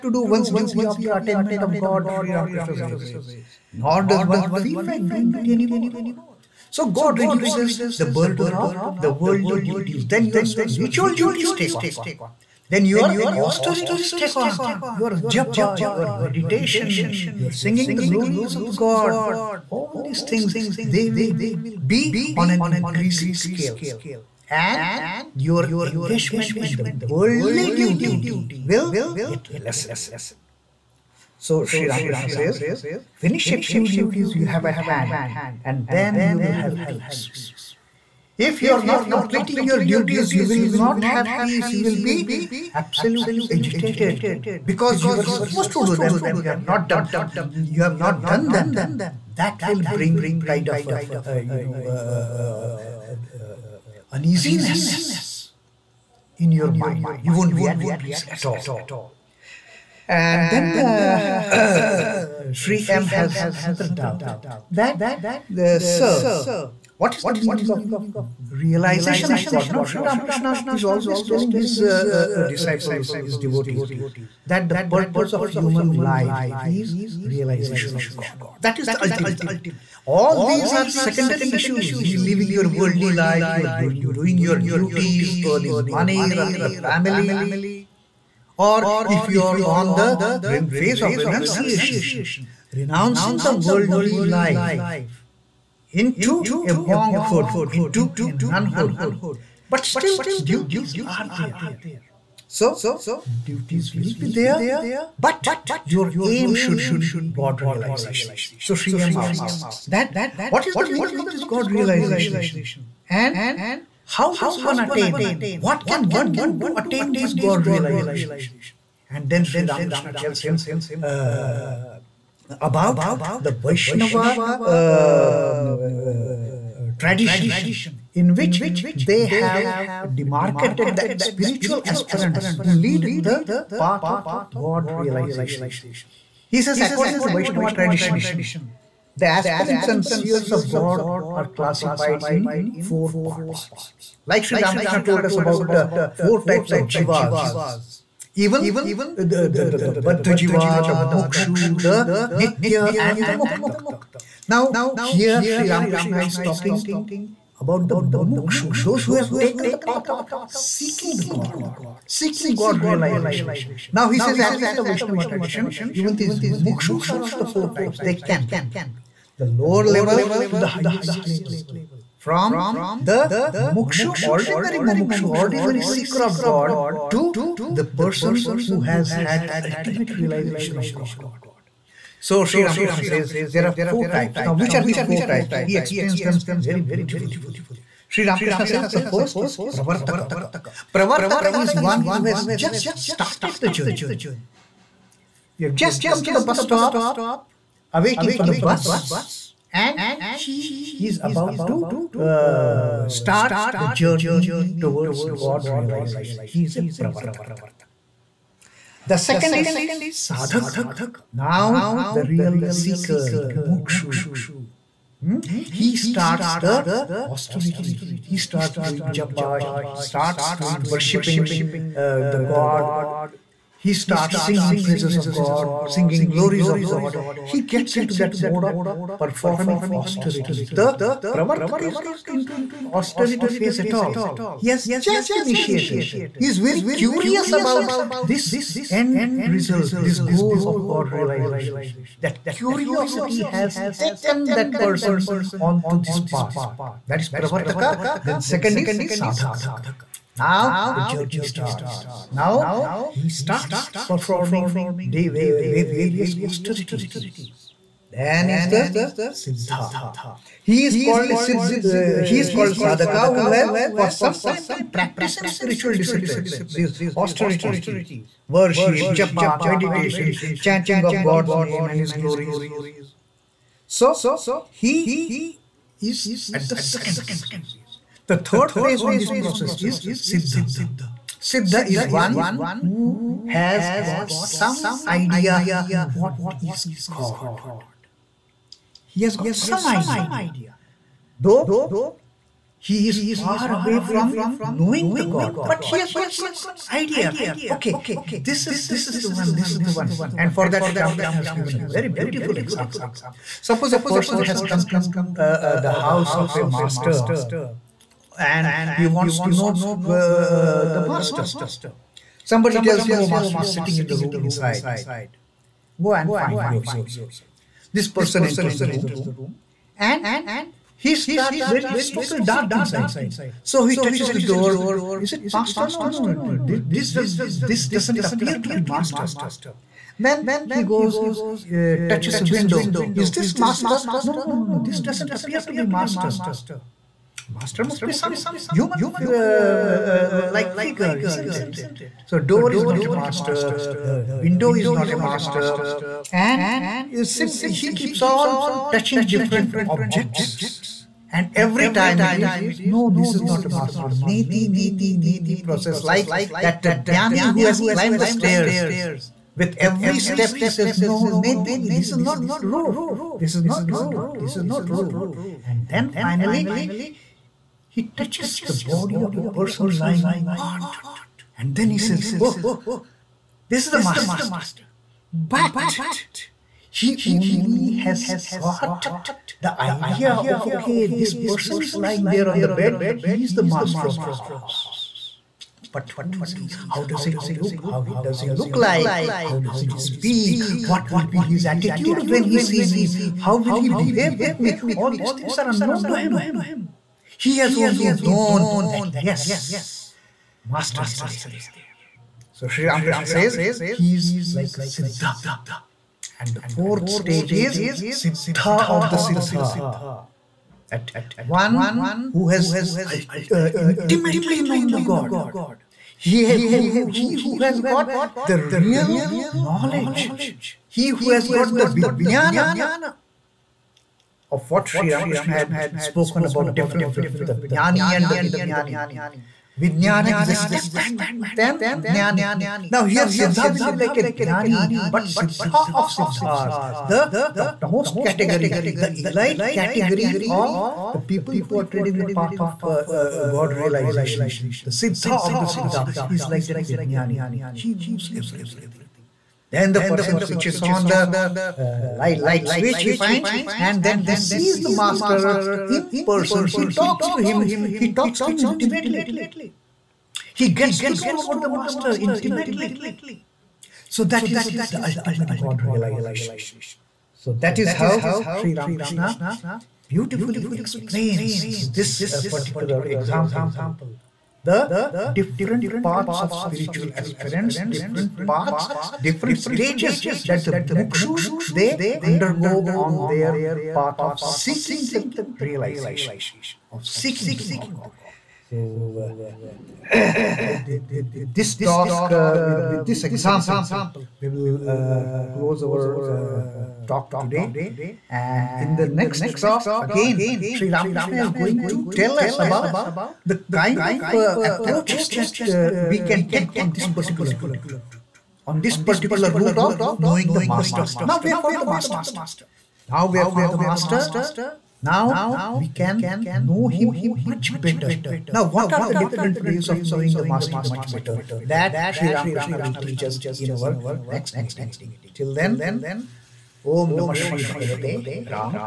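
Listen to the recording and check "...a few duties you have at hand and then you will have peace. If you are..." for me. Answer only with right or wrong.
right.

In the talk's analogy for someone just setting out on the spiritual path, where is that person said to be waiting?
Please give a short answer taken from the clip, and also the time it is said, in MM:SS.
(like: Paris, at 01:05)
bus stop, at 03:16.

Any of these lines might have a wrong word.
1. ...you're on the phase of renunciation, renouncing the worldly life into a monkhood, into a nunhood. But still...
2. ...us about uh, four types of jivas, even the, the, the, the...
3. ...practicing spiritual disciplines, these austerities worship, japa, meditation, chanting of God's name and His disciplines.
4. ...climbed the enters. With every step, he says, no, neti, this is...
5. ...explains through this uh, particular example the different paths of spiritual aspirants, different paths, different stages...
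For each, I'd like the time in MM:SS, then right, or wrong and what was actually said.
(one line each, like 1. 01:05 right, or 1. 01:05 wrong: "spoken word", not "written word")
1. 01:29 right
2. 02:25 right
3. 04:24 wrong: "glories", not "disciplines"
4. 05:57 wrong: "stairs", not "enters"
5. 07:50 right.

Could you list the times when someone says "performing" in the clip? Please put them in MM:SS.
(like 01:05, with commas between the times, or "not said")
03:49, 04:14.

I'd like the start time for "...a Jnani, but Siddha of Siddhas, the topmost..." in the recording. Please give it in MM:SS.
07:14.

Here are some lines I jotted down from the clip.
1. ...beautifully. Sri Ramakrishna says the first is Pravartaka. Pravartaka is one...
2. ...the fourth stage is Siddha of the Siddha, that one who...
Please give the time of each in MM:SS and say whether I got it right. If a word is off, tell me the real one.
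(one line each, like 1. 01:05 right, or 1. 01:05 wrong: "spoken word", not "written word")
1. 03:06 right
2. 06:46 right.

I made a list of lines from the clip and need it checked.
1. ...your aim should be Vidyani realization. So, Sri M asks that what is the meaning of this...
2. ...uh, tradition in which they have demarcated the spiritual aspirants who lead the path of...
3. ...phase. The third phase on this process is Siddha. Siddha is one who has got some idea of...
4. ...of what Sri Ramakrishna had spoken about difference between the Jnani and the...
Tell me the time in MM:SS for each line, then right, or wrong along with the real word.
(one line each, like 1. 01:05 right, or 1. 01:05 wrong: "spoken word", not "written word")
1. 01:45 wrong: "God", not "Vidyani"
2. 02:05 right
3. 04:37 right
4. 07:04 right.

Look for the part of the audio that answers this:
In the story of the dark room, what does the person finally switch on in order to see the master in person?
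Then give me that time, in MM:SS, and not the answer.
07:32.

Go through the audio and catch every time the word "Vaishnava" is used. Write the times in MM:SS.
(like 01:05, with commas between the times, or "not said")
02:03, 02:17, 02:44.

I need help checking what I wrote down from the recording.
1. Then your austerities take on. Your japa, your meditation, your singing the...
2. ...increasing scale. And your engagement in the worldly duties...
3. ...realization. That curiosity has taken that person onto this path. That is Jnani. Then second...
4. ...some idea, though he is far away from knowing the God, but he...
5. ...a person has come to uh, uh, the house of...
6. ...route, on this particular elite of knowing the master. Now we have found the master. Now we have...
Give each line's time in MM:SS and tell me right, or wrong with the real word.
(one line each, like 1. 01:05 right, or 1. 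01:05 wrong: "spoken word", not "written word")
1. 00:12 right
2. 00:22 right
3. 04:01 wrong: "Pravartaka", not "Jnani"
4. 04:49 right
5. 05:03 right
6. 08:27 wrong: "route", not "elite".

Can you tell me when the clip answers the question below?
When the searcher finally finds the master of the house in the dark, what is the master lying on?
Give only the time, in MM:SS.
06:09.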